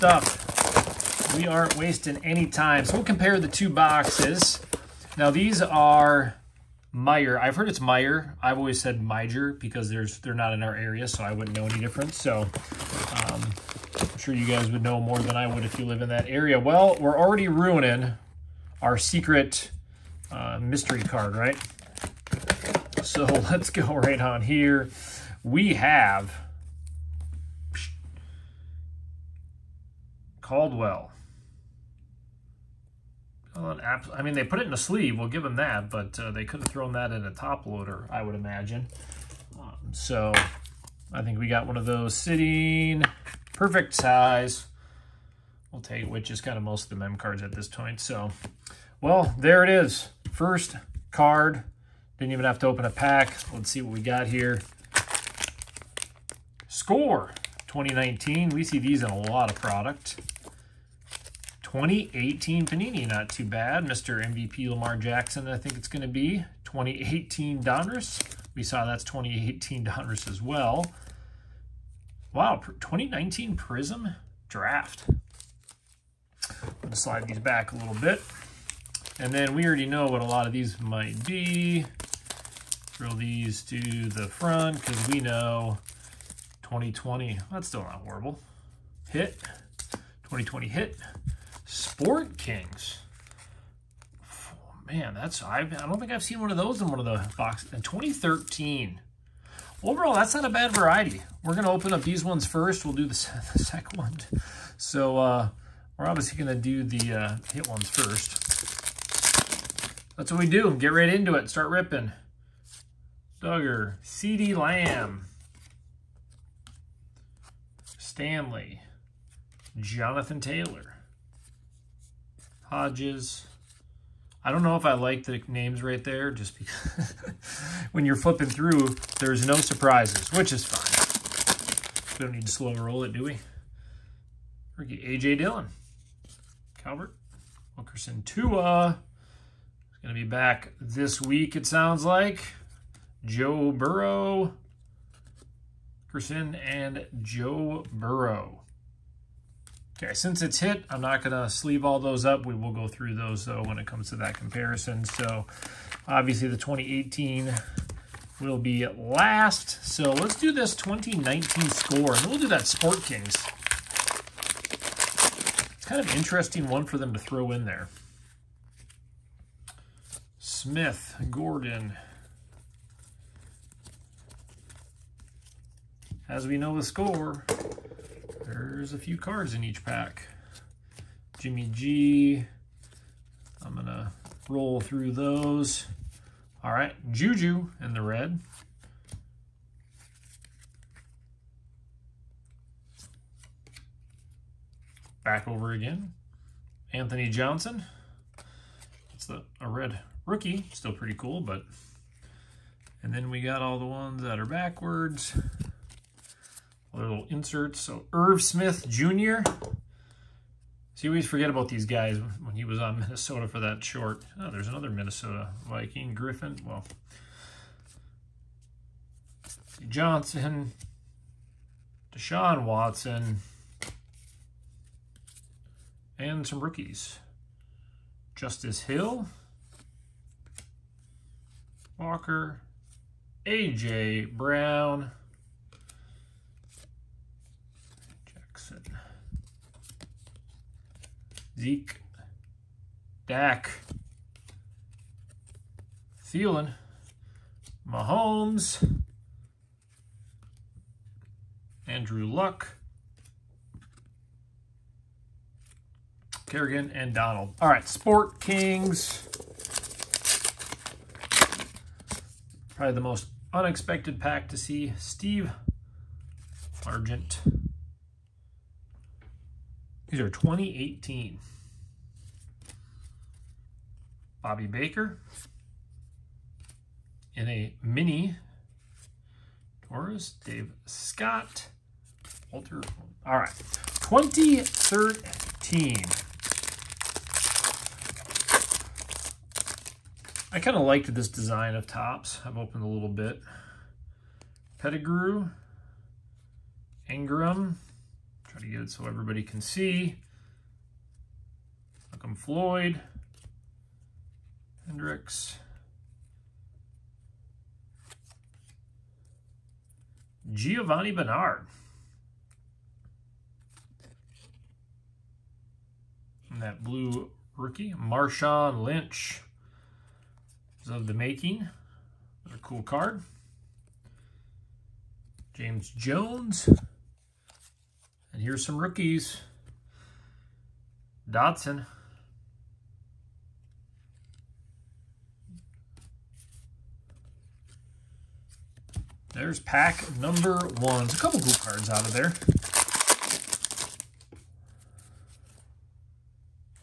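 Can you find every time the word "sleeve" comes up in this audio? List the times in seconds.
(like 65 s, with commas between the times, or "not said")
34 s, 151 s.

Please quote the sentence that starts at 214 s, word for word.
Oh, there's another Minnesota Viking, Griffin.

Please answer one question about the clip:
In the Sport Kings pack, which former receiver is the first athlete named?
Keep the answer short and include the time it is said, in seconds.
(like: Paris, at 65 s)
Steve Largent, at 264 s.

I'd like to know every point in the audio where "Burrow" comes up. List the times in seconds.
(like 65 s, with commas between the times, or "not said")
143 s, 147 s.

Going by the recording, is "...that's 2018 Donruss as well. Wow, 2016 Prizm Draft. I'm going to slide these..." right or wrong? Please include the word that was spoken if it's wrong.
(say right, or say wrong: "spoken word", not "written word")
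wrong: "2019", not "2016".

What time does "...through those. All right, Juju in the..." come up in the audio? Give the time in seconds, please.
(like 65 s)
184 s.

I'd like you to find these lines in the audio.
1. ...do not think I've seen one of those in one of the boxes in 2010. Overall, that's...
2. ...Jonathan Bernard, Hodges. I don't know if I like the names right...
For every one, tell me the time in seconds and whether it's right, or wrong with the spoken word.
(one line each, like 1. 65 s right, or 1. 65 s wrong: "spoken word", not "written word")
1. 95 s wrong: "2013", not "2010"
2. 119 s wrong: "Taylor", not "Bernard".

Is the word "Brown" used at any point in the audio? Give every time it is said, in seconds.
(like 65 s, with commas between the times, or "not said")
234 s.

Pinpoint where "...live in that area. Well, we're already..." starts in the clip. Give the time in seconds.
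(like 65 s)
15 s.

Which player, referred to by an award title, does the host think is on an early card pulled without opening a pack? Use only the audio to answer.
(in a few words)
Lamar Jackson.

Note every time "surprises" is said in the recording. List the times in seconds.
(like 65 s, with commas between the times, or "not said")
129 s.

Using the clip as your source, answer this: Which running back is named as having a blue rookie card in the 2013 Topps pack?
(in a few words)
Marshawn Lynch.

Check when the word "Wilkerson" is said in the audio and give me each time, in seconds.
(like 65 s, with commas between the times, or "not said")
137 s, 146 s.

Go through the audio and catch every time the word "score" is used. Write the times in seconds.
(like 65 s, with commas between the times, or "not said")
56 s, 161 s, 176 s.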